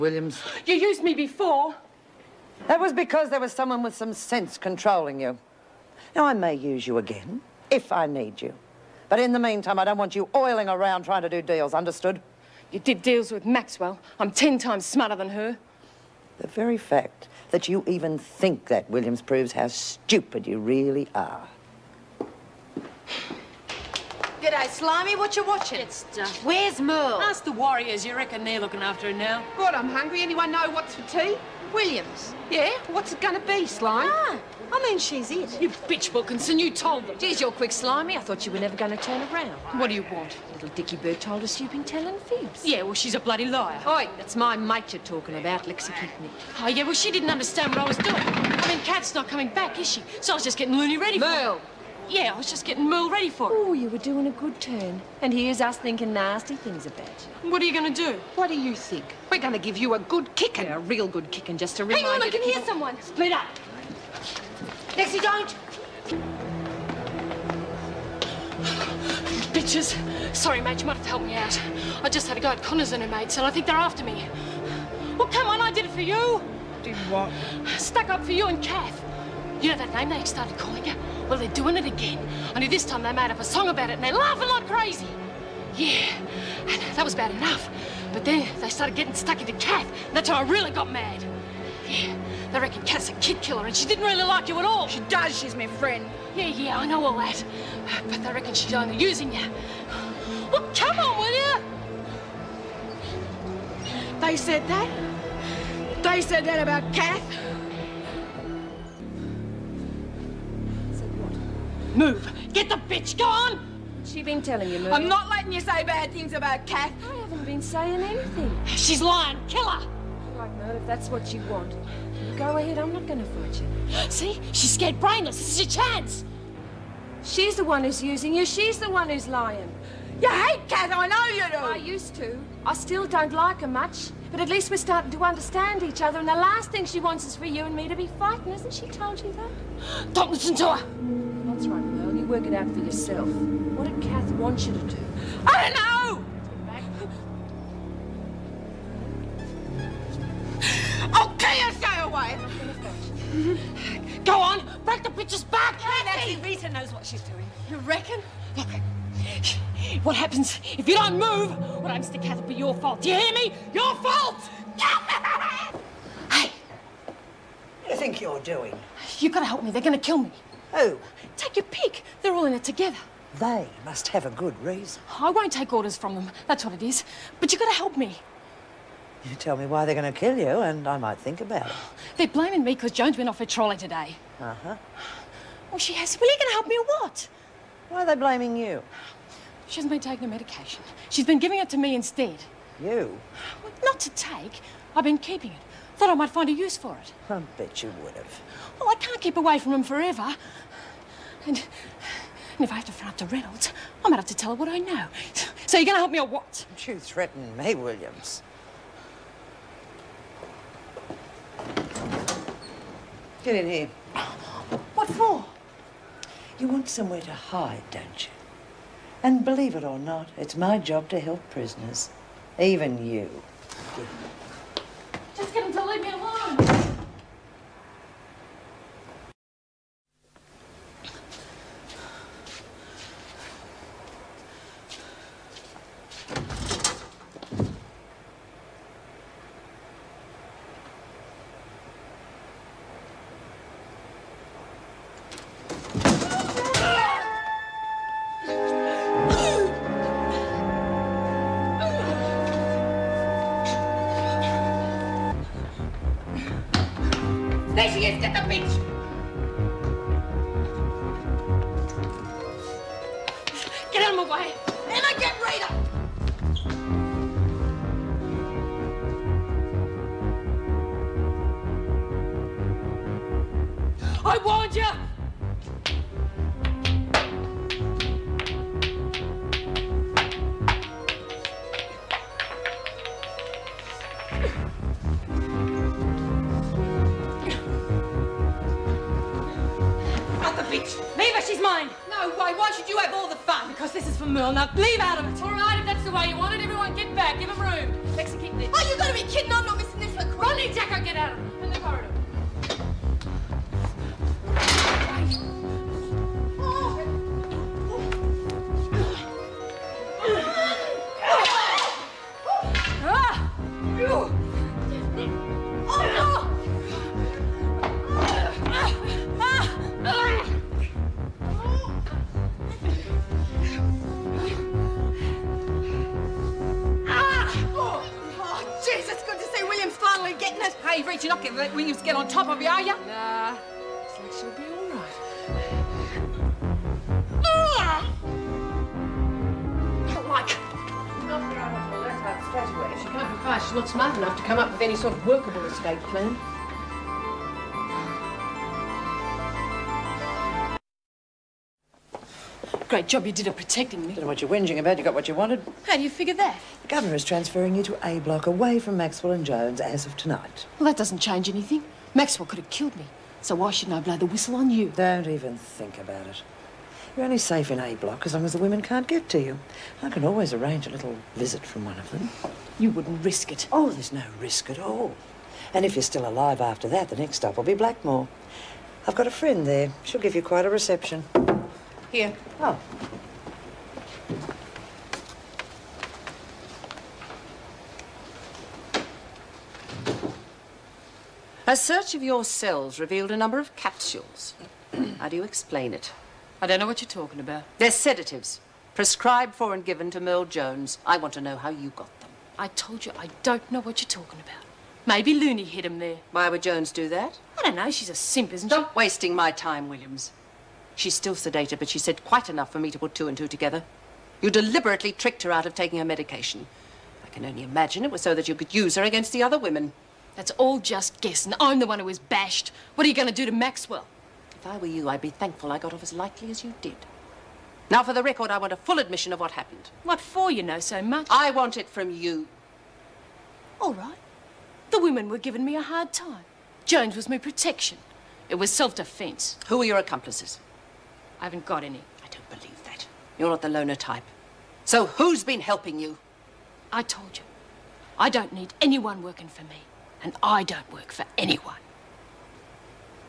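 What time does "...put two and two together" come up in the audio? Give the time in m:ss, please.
6:52.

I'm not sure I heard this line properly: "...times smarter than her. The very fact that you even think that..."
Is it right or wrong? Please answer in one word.
right.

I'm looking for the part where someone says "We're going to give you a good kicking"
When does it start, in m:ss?
0:59.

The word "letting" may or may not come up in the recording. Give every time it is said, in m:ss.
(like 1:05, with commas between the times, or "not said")
1:55.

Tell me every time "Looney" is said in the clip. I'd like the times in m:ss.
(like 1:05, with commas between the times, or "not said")
0:50, 6:45.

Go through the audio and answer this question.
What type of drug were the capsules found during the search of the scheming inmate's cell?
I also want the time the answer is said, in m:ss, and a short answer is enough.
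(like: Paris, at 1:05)
sedatives, at 6:37.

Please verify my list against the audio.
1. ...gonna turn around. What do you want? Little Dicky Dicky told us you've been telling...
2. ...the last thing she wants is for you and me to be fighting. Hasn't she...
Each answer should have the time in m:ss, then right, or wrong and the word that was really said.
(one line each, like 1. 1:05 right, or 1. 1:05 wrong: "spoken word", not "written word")
1. 0:38 wrong: "Bird", not "Dicky"
2. 2:16 right.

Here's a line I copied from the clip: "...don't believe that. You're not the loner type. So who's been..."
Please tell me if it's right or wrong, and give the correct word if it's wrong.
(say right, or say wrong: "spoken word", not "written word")
right.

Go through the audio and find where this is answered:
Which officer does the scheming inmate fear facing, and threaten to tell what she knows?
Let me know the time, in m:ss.
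3:23.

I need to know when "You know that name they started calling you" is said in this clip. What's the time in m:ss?
1:19.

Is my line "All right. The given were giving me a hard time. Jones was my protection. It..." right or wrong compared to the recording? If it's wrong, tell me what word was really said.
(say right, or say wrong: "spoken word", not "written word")
wrong: "women", not "given".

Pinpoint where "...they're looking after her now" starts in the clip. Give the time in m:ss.
0:28.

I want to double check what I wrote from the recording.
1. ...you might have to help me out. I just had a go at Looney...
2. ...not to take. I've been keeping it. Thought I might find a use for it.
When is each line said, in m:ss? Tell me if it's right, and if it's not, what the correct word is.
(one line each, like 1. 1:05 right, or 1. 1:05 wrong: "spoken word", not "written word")
1. 1:10 wrong: "Connors", not "Looney"
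2. 3:13 right.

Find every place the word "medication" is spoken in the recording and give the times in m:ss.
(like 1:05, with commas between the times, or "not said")
3:10, 6:56.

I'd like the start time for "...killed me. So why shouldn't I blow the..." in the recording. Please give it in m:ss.
6:02.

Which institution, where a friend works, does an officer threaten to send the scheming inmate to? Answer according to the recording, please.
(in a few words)
Blackmore.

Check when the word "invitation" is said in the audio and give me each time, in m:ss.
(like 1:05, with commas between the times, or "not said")
not said.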